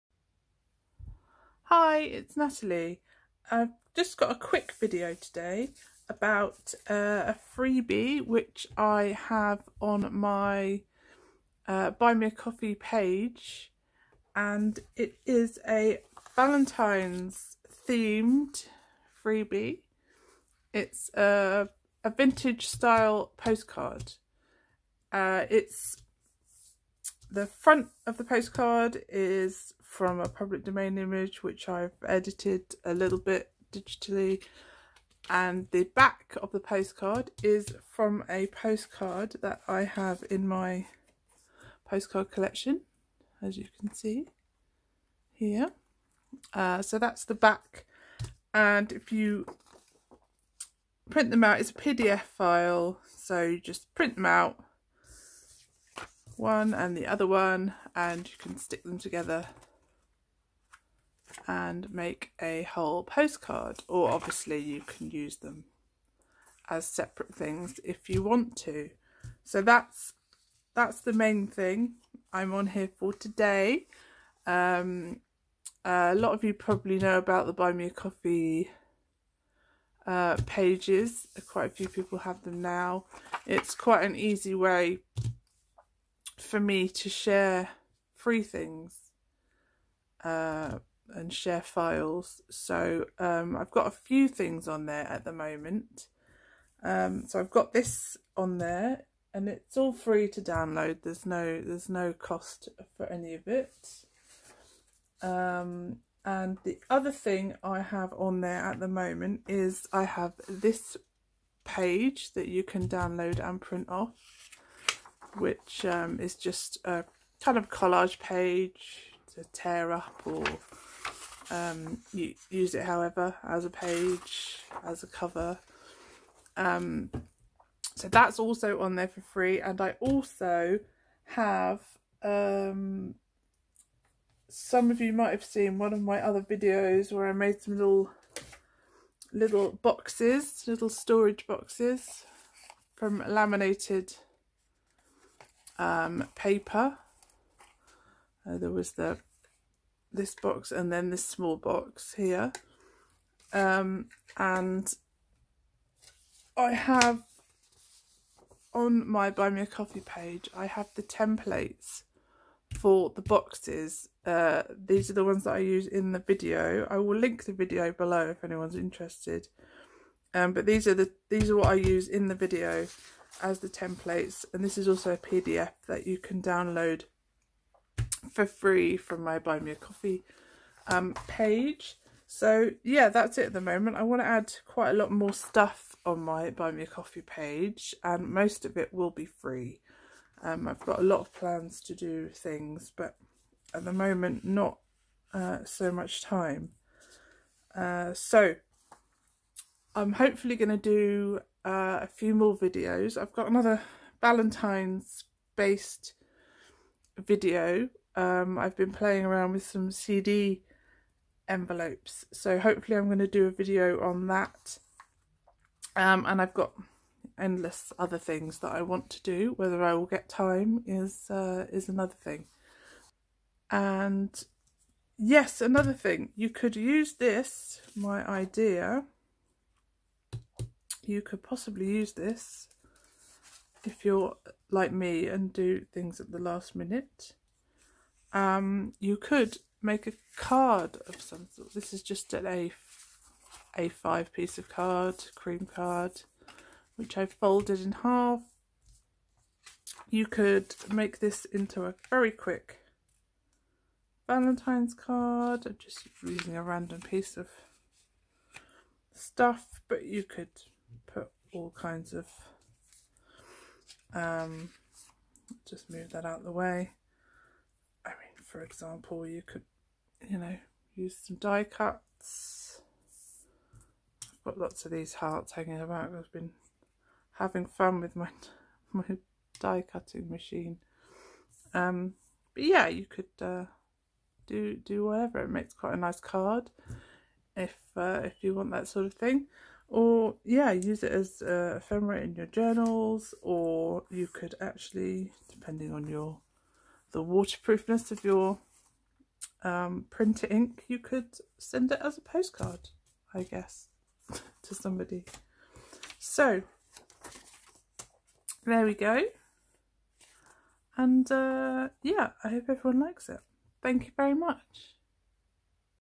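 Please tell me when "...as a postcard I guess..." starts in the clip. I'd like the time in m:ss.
5:02.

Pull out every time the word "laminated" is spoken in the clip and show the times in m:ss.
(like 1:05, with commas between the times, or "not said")
2:23.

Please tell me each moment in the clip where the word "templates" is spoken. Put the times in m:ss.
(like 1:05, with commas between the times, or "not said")
2:41, 2:53.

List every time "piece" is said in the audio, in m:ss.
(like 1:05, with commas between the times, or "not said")
4:04, 4:17.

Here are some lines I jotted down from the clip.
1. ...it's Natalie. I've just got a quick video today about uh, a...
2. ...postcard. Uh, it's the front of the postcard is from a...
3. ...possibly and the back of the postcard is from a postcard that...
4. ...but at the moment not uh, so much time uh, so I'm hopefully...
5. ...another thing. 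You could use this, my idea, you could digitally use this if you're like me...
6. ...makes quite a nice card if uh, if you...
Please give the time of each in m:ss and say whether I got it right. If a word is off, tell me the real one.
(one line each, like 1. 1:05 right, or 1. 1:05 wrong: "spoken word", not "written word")
1. 0:01 right
2. 0:23 right
3. 0:33 wrong: "digitally", not "possibly"
4. 3:12 right
5. 3:45 wrong: "possibly", not "digitally"
6. 4:45 right.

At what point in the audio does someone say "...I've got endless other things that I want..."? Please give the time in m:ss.
3:36.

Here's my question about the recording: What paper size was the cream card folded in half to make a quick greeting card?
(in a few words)
A5.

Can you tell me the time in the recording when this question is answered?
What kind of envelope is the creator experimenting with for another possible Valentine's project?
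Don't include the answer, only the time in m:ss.
3:29.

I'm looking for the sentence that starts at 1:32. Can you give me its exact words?
So um, I've got a few things on there at the moment.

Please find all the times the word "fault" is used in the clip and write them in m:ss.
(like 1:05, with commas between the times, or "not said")
not said.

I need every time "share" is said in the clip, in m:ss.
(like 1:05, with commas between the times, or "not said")
1:27, 1:31.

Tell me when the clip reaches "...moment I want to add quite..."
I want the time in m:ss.
3:03.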